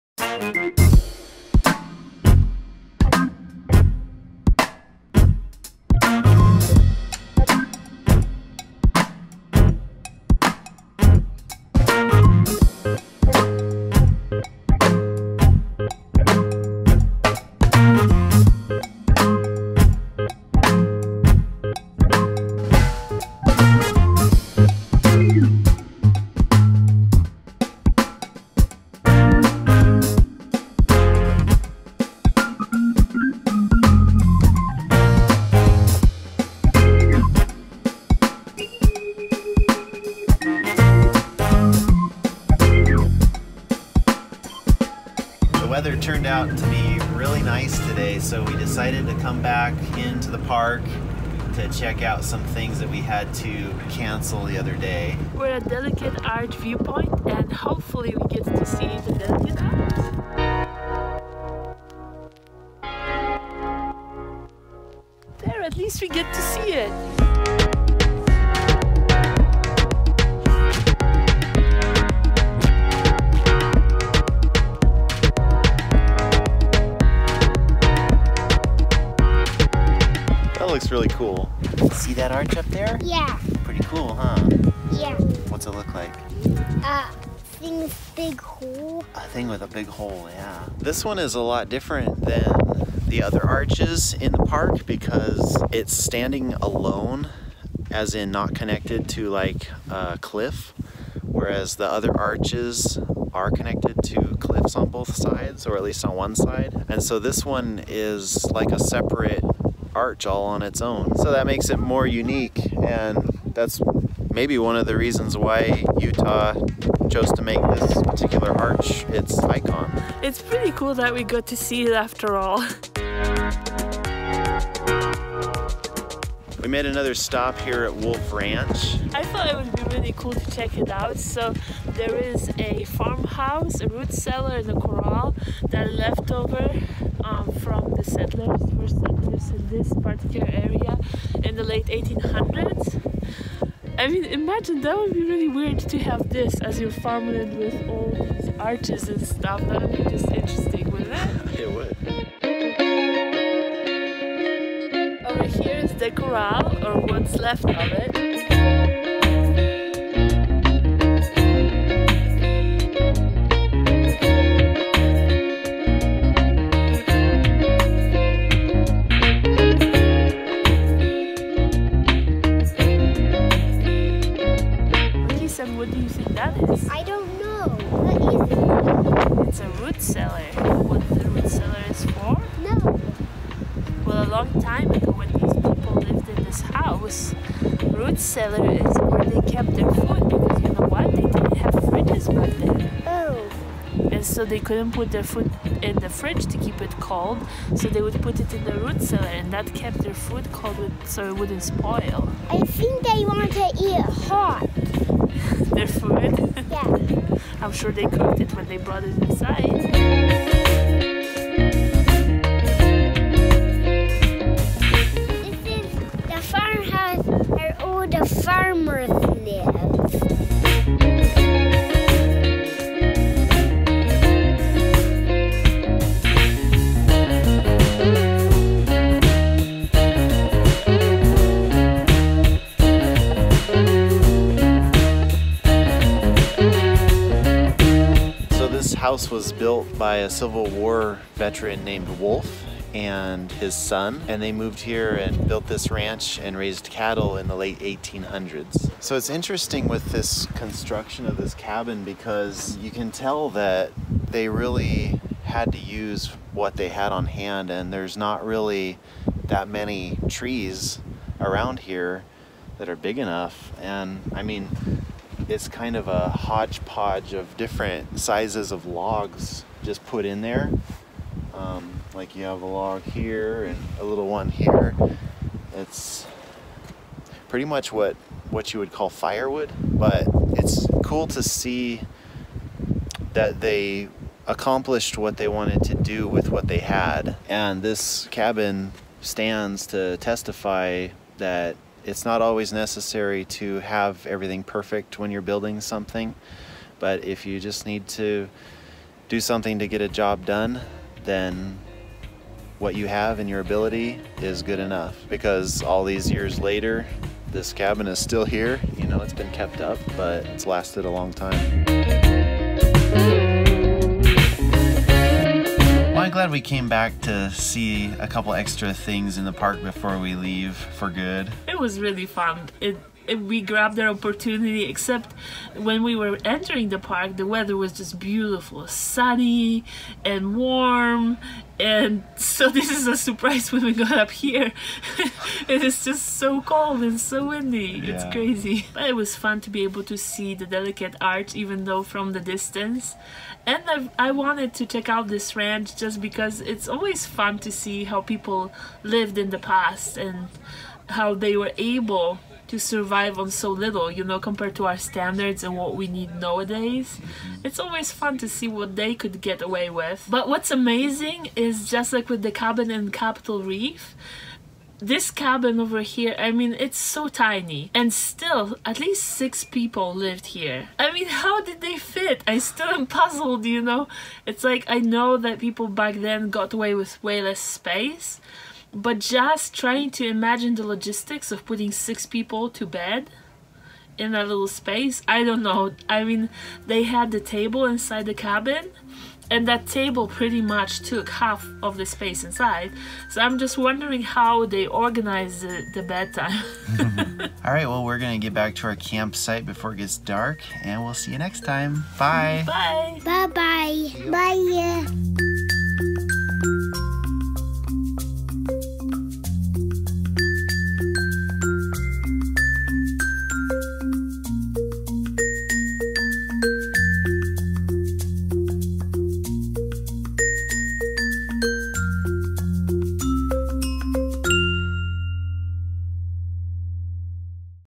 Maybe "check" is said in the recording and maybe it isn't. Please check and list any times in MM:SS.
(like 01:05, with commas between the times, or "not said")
00:51, 02:10, 05:44.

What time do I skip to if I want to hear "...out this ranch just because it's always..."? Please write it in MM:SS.
05:45.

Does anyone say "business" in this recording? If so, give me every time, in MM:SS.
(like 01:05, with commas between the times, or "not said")
not said.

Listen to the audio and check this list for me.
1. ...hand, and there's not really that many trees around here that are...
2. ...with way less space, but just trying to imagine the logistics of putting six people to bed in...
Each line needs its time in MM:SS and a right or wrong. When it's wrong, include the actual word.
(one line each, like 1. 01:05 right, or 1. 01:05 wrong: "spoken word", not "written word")
1. 04:17 right
2. 06:16 right.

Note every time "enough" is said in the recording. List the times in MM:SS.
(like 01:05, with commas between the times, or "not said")
04:23, 05:04.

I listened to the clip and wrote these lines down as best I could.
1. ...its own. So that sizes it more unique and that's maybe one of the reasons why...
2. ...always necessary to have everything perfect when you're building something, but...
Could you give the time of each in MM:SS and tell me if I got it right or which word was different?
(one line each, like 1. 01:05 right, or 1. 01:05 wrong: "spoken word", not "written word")
1. 01:50 wrong: "makes", not "sizes"
2. 04:52 right.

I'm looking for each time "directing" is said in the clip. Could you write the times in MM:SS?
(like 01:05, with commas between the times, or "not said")
not said.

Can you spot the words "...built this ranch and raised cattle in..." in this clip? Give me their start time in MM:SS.
04:05.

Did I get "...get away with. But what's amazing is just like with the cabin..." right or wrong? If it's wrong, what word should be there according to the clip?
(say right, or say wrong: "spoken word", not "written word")
right.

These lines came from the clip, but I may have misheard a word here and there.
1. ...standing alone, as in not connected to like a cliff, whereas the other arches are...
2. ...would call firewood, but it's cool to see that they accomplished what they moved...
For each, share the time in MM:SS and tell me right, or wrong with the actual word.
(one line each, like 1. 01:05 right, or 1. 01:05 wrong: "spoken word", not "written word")
1. 01:35 right
2. 04:38 wrong: "wanted", not "moved".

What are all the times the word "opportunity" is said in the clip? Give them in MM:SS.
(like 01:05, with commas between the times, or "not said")
05:24.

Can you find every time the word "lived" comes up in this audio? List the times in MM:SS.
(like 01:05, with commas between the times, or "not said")
03:06, 05:49, 06:10.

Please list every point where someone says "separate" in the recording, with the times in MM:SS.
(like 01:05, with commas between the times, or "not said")
01:48.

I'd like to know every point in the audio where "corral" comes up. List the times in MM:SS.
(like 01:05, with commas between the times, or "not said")
02:14, 02:36.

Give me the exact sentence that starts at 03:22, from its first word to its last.
I think they want to eat hot their food.